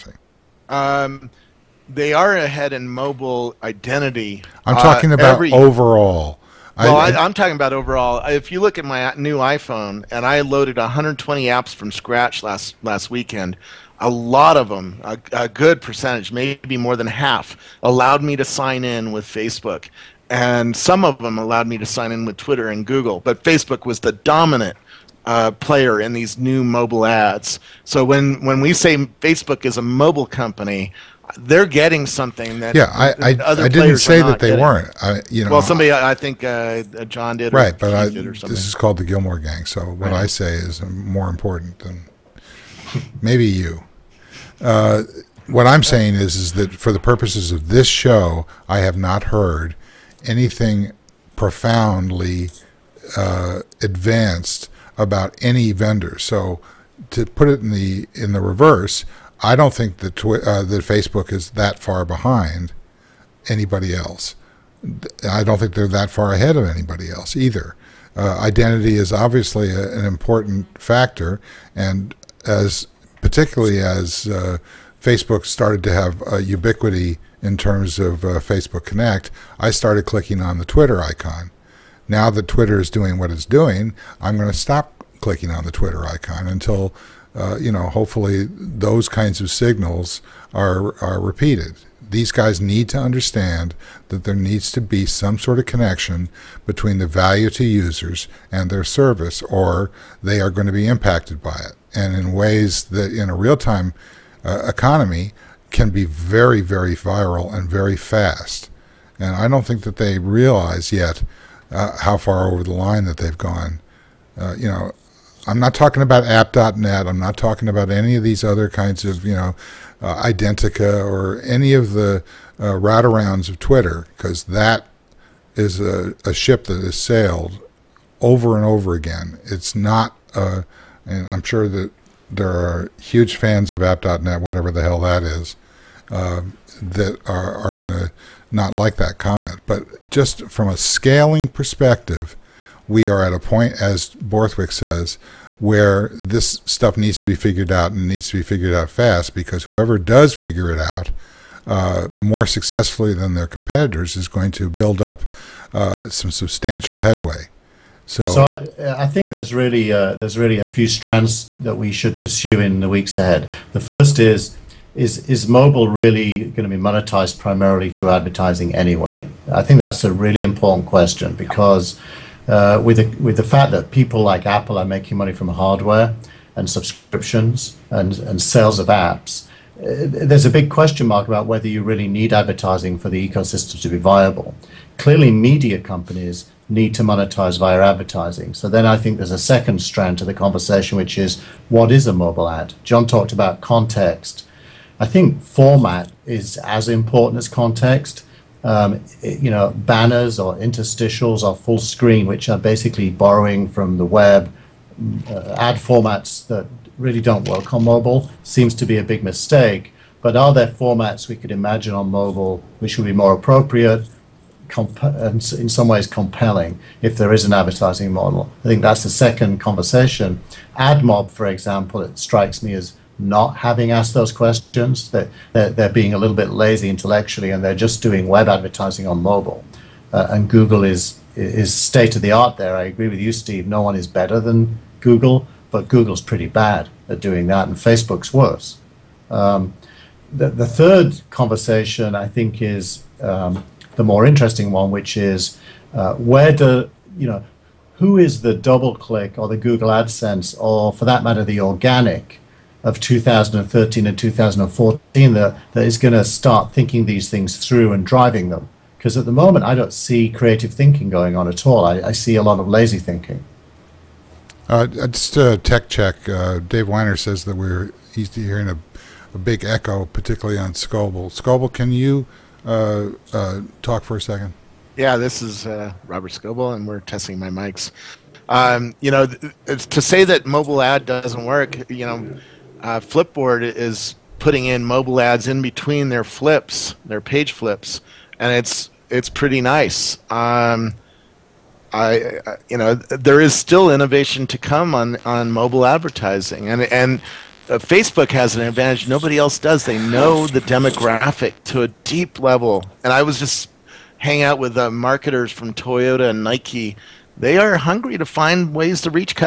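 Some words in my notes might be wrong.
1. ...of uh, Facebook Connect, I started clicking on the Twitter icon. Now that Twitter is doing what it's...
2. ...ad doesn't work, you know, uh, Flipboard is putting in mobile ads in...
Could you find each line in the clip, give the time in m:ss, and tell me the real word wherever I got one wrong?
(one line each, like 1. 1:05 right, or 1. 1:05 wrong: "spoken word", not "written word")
1. 1:17 right
2. 4:40 right.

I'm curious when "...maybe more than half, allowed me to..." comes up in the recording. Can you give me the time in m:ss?
0:16.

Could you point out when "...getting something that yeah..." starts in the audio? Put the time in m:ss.
0:31.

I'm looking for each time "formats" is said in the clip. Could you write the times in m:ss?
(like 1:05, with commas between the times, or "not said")
3:15, 3:25, 3:30.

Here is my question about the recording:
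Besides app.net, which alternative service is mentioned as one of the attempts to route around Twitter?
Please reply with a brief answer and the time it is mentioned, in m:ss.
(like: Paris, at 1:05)
Identica, at 2:00.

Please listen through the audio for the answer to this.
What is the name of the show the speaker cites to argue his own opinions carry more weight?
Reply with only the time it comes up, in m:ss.
0:39.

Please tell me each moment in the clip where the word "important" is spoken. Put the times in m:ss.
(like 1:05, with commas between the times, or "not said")
0:41, 1:10, 2:50, 3:16.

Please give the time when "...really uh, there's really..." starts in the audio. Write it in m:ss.
2:39.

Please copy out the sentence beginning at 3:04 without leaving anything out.
Clearly, media companies need to monetize via advertising.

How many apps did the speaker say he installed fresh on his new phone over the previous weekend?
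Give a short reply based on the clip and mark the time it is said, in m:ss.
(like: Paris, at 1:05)
120, at 0:10.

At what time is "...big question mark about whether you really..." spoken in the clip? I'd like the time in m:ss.
3:00.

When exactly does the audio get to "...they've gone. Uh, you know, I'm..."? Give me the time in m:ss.
1:53.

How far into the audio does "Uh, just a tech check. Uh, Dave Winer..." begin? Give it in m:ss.
4:24.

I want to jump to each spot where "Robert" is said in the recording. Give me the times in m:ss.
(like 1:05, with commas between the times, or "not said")
4:36.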